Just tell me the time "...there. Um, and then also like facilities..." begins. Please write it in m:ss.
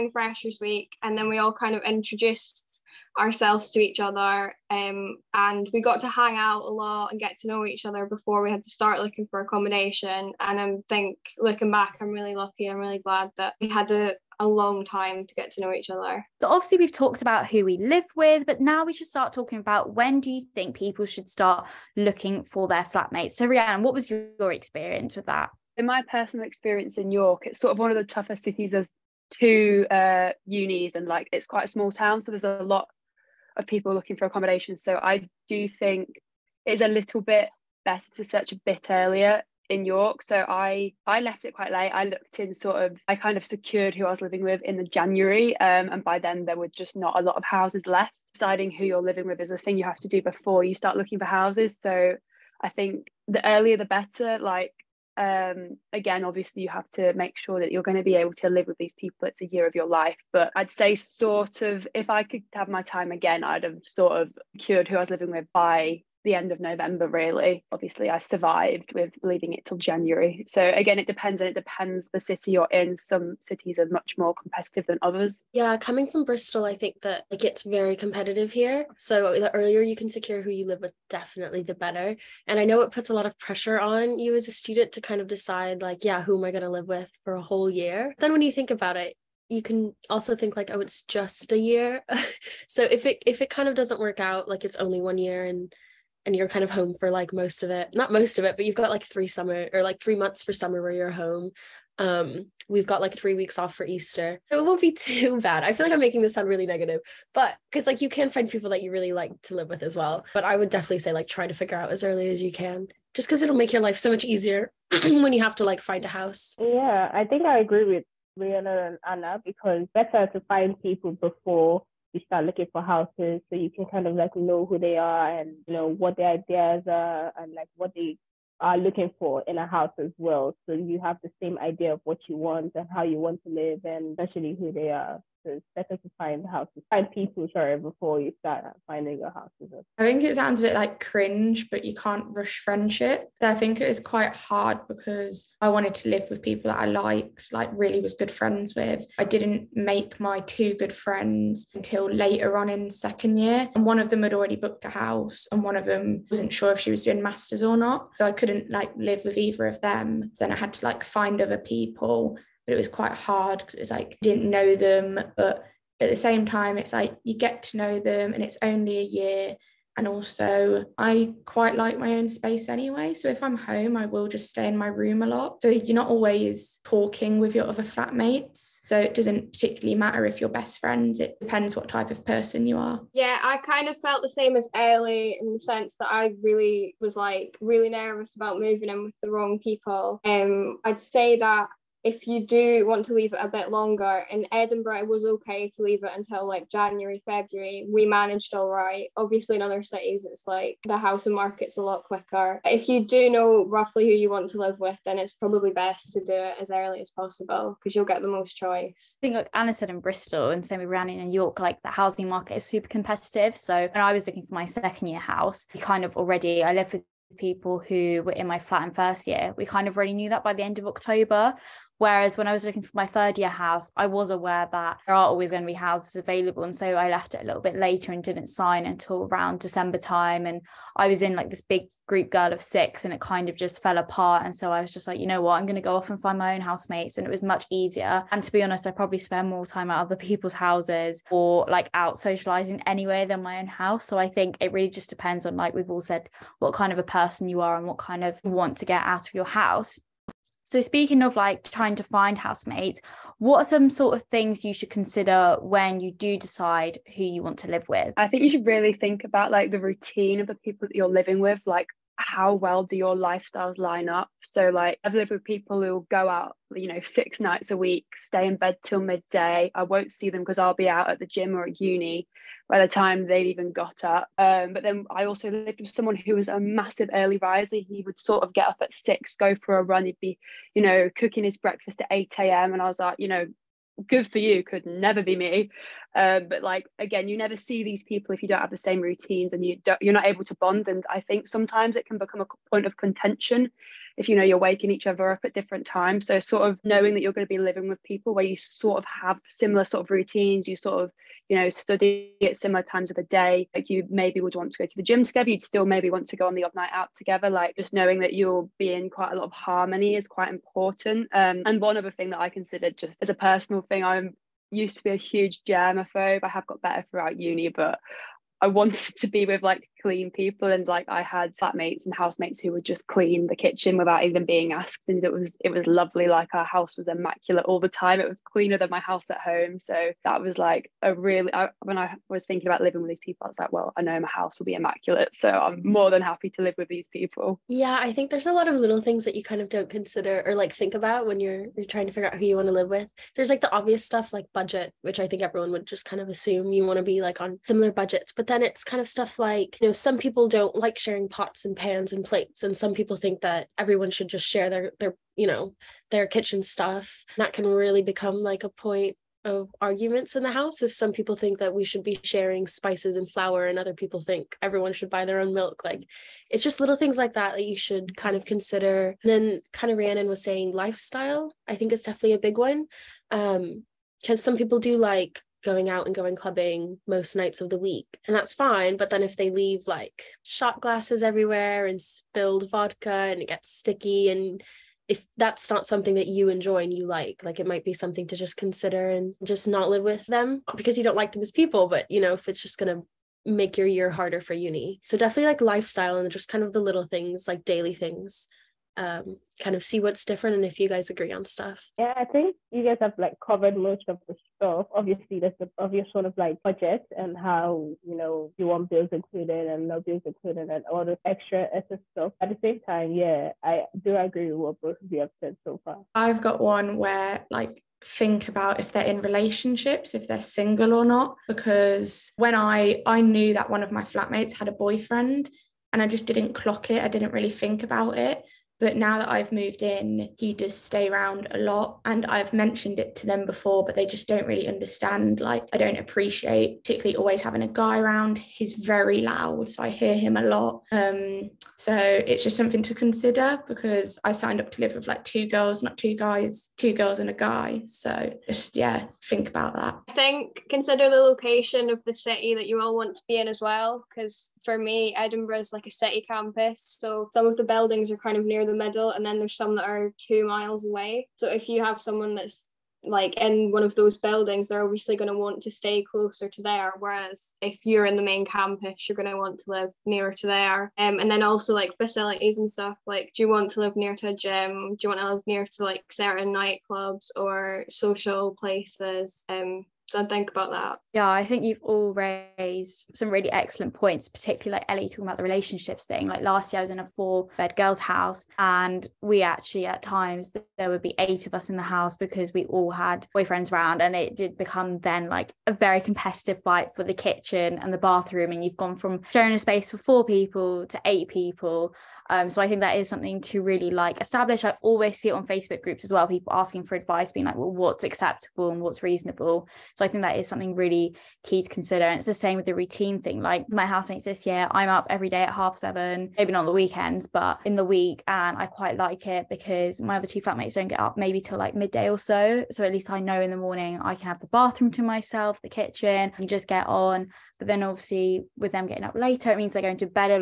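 7:50.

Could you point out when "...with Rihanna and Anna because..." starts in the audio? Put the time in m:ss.
1:57.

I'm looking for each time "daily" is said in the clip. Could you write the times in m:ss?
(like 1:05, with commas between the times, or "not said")
6:37.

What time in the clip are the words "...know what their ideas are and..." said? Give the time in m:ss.
2:05.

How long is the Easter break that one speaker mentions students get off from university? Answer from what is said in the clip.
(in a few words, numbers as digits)
Three weeks.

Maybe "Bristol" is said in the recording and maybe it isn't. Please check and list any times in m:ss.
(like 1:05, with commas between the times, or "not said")
1:16, 3:29.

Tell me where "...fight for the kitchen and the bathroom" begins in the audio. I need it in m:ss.
8:16.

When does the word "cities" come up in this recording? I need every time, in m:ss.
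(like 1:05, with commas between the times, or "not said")
0:28, 1:13, 3:19.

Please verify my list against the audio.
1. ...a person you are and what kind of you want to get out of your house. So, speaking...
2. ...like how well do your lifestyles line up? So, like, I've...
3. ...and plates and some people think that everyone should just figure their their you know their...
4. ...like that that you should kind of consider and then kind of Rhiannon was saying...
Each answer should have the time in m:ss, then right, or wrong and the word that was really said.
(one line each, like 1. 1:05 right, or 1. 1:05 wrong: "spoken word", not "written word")
1. 4:06 right
2. 4:21 right
3. 5:52 wrong: "share", not "figure"
4. 6:07 right.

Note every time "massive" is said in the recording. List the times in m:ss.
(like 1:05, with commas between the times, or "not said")
4:36.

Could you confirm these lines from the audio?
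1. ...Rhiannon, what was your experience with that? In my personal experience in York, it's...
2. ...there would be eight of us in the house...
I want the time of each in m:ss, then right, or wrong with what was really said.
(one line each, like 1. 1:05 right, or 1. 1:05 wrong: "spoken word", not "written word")
1. 0:23 right
2. 8:10 right.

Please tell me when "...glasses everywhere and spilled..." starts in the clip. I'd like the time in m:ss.
6:20.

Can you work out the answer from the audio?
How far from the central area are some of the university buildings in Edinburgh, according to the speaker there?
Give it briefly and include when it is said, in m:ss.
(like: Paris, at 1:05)
Two miles, at 7:40.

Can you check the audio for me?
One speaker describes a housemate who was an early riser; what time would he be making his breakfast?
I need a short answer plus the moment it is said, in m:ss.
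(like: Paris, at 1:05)
8 a.m., at 4:41.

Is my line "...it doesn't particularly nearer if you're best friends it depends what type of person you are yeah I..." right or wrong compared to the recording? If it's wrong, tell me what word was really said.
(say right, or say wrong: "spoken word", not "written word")
wrong: "matter", not "nearer".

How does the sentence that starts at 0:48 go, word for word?
Deciding who you're living with is a thing you have to do before you start looking for houses.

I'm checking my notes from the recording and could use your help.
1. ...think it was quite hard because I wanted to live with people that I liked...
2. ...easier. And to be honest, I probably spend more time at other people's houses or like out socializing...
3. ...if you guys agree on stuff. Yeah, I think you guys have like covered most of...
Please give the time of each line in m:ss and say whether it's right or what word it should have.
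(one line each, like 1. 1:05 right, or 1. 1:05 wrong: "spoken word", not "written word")
1. 2:23 right
2. 3:57 right
3. 6:40 right.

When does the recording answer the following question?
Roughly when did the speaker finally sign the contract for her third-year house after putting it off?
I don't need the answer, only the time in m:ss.
3:48.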